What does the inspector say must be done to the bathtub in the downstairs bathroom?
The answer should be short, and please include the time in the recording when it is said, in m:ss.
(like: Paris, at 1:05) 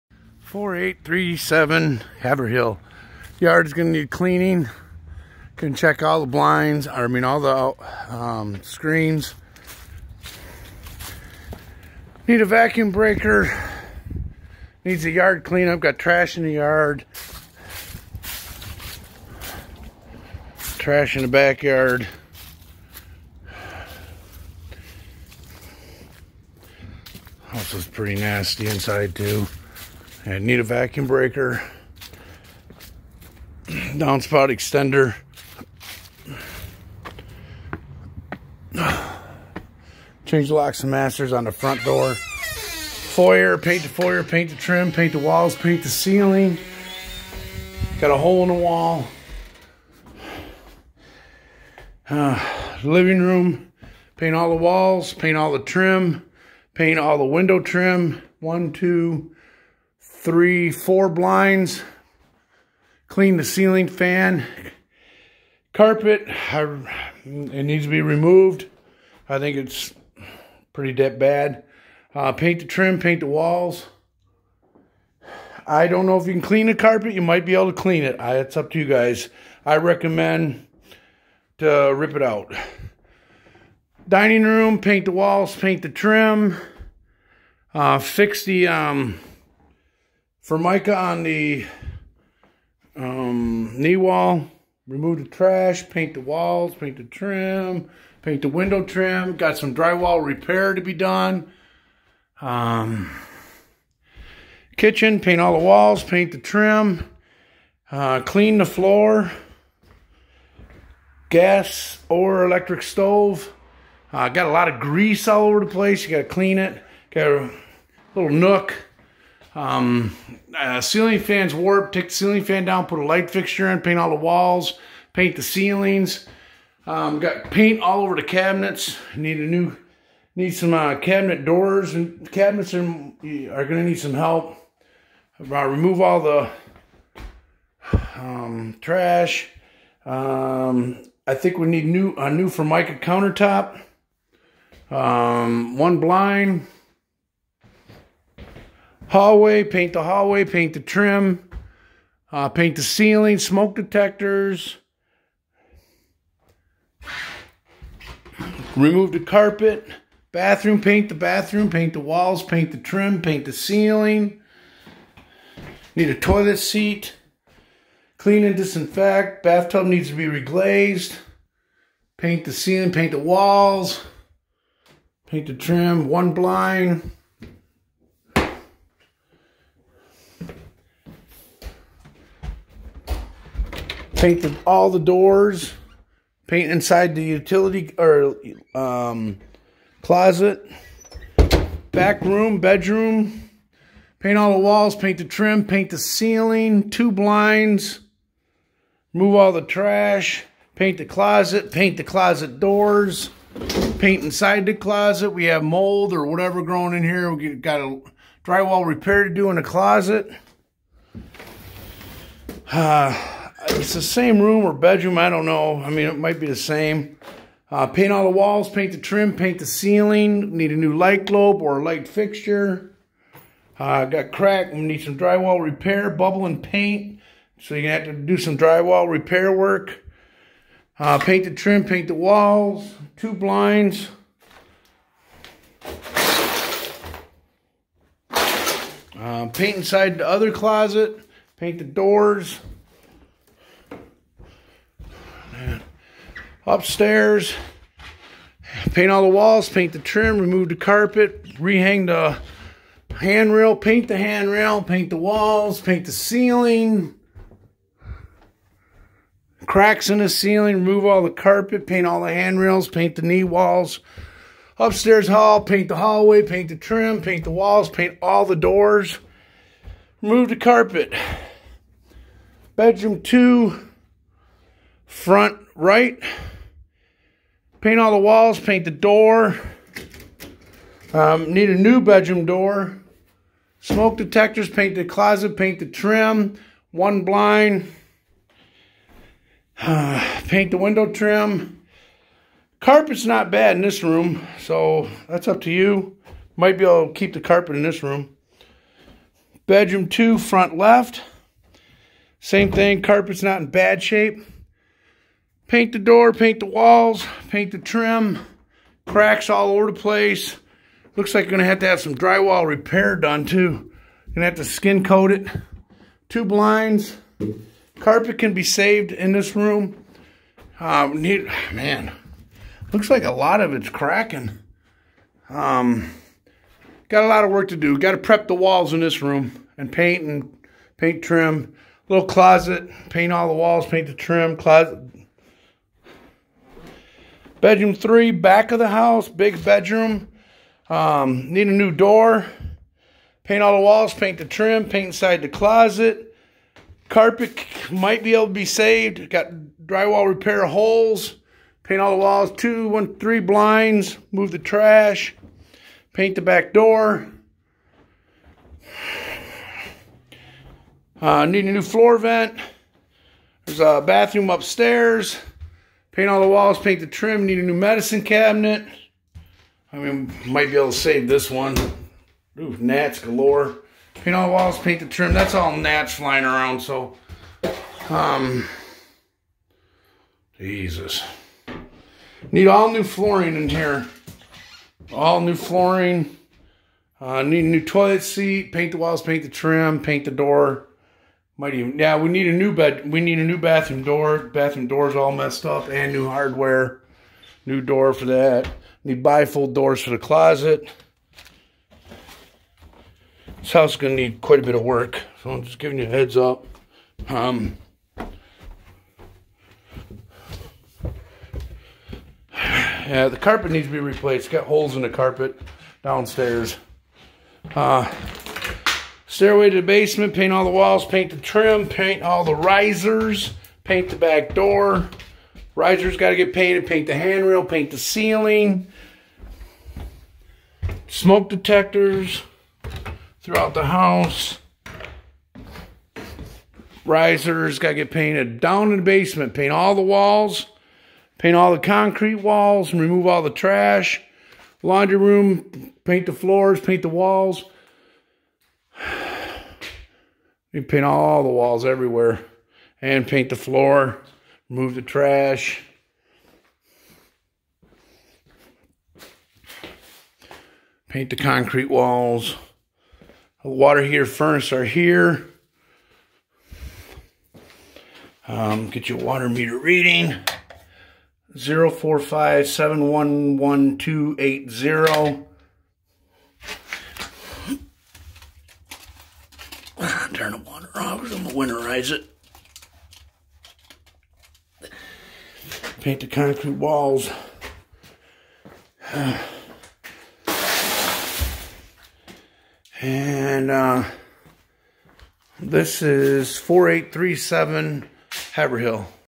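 reglazed, at 2:50.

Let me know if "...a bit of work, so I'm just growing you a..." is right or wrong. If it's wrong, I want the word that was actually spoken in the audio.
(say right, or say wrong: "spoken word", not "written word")
wrong: "giving", not "growing".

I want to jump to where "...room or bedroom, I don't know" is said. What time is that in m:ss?
3:34.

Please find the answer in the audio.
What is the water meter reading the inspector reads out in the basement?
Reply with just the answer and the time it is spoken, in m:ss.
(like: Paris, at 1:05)
045711280, at 7:51.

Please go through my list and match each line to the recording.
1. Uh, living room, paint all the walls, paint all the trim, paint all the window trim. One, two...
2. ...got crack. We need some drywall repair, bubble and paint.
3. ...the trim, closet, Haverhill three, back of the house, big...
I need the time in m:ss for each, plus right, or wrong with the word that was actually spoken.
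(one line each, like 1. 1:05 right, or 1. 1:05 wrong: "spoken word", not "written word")
1. 0:52 right
2. 3:44 right
3. 5:34 wrong: "Bedroom", not "Haverhill".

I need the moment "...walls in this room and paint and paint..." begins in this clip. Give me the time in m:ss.
5:28.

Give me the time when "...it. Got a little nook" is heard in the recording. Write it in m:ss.
1:56.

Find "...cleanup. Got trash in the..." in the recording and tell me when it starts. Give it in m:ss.
0:15.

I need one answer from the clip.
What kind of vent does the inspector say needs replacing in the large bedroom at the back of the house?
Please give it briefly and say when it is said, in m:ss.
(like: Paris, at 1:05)
floor vent, at 6:01.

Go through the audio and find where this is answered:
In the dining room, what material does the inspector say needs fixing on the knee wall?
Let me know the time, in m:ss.
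1:30.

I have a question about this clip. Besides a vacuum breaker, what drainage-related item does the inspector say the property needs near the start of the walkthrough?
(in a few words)
downspout extender.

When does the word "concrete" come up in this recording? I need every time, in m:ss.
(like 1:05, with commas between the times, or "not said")
7:21, 7:41, 8:06.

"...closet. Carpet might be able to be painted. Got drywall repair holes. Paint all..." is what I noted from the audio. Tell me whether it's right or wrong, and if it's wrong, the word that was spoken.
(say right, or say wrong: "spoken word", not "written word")
wrong: "saved", not "painted".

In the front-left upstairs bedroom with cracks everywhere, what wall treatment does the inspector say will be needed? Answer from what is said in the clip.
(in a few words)
skin coat.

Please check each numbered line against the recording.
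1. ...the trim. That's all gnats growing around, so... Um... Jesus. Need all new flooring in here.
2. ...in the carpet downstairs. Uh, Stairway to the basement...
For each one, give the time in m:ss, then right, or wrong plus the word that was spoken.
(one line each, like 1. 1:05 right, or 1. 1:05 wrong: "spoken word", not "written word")
1. 6:14 wrong: "flying", not "growing"
2. 6:54 right.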